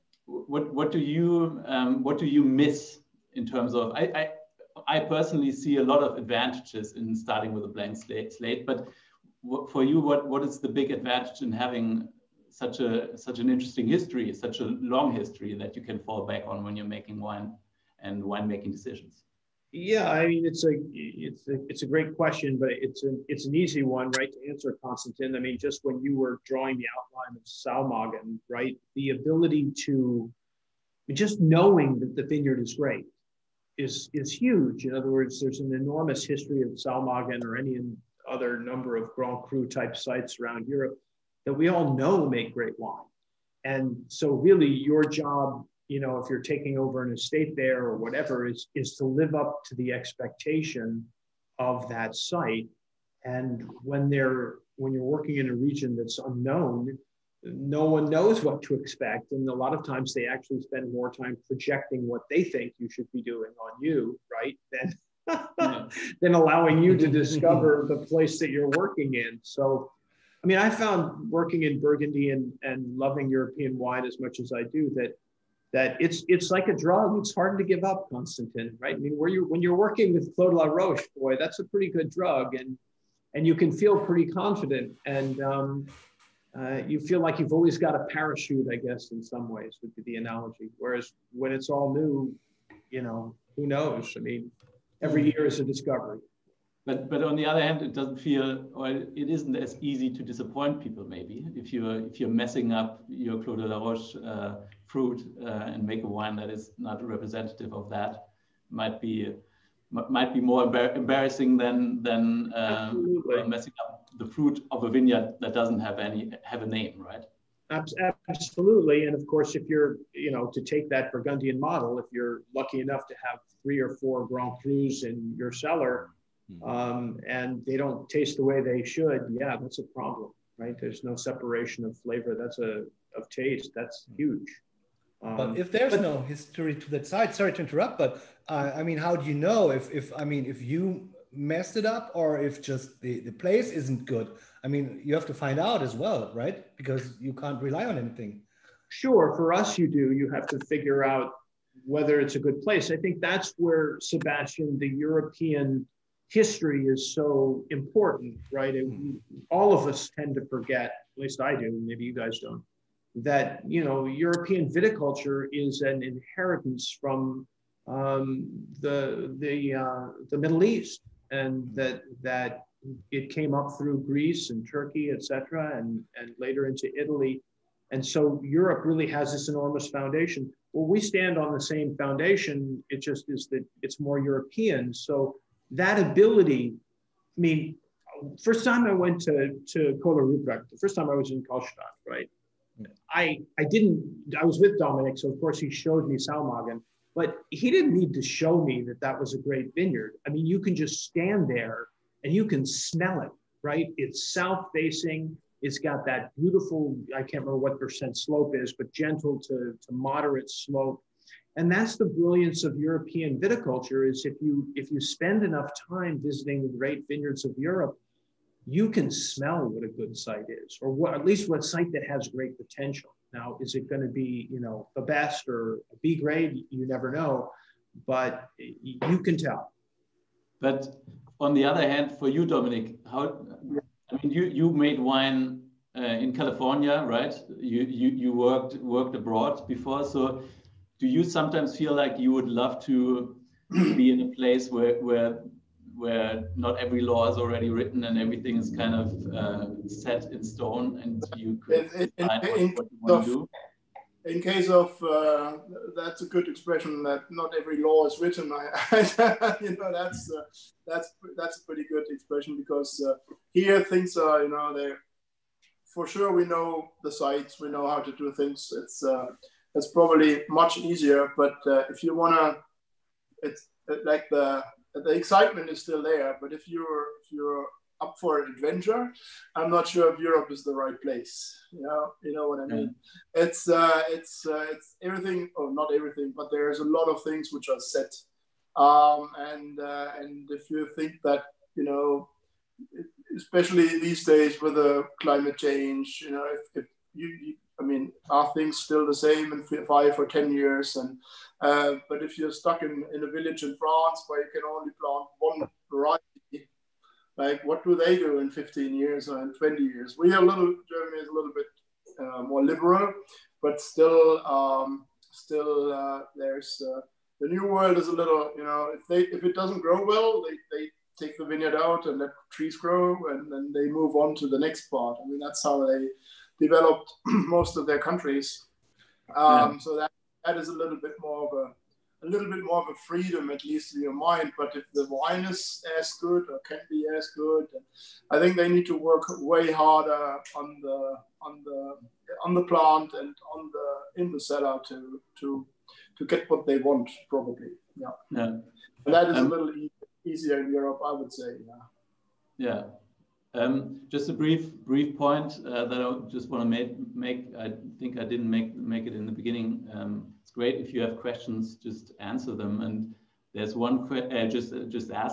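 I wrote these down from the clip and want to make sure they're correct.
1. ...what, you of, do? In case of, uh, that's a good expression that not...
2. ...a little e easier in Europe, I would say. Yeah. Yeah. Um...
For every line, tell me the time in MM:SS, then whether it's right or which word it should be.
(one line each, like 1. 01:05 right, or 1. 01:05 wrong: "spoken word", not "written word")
1. 04:12 right
2. 05:49 right.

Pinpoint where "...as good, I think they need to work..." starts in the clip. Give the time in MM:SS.
05:37.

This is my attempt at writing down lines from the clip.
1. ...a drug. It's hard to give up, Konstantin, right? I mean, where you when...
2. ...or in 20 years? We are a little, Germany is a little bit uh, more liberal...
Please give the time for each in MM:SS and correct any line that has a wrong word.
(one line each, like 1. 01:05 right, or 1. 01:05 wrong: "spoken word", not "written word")
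1. 01:16 right
2. 05:09 right.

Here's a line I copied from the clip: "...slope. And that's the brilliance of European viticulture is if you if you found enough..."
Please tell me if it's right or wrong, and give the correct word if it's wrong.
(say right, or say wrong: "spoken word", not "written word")
wrong: "spend", not "found".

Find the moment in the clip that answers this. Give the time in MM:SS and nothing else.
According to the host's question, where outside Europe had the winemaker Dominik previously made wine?
03:56.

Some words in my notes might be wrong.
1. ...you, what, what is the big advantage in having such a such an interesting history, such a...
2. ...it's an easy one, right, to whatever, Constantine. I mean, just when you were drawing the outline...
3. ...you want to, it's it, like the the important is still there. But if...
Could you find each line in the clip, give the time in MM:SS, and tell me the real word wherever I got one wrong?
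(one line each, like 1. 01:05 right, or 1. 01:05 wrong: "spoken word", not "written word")
1. 00:09 right
2. 00:23 wrong: "answer", not "whatever"
3. 04:32 wrong: "excitement", not "important".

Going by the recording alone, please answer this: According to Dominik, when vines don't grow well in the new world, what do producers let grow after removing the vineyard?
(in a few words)
trees.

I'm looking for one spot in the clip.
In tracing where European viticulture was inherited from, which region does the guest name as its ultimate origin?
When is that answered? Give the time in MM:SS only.
02:50.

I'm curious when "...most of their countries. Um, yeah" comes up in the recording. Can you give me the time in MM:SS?
05:27.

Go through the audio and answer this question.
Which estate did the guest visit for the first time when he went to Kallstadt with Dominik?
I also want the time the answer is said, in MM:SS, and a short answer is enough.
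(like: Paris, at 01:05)
Köhler Ruprecht, at 03:10.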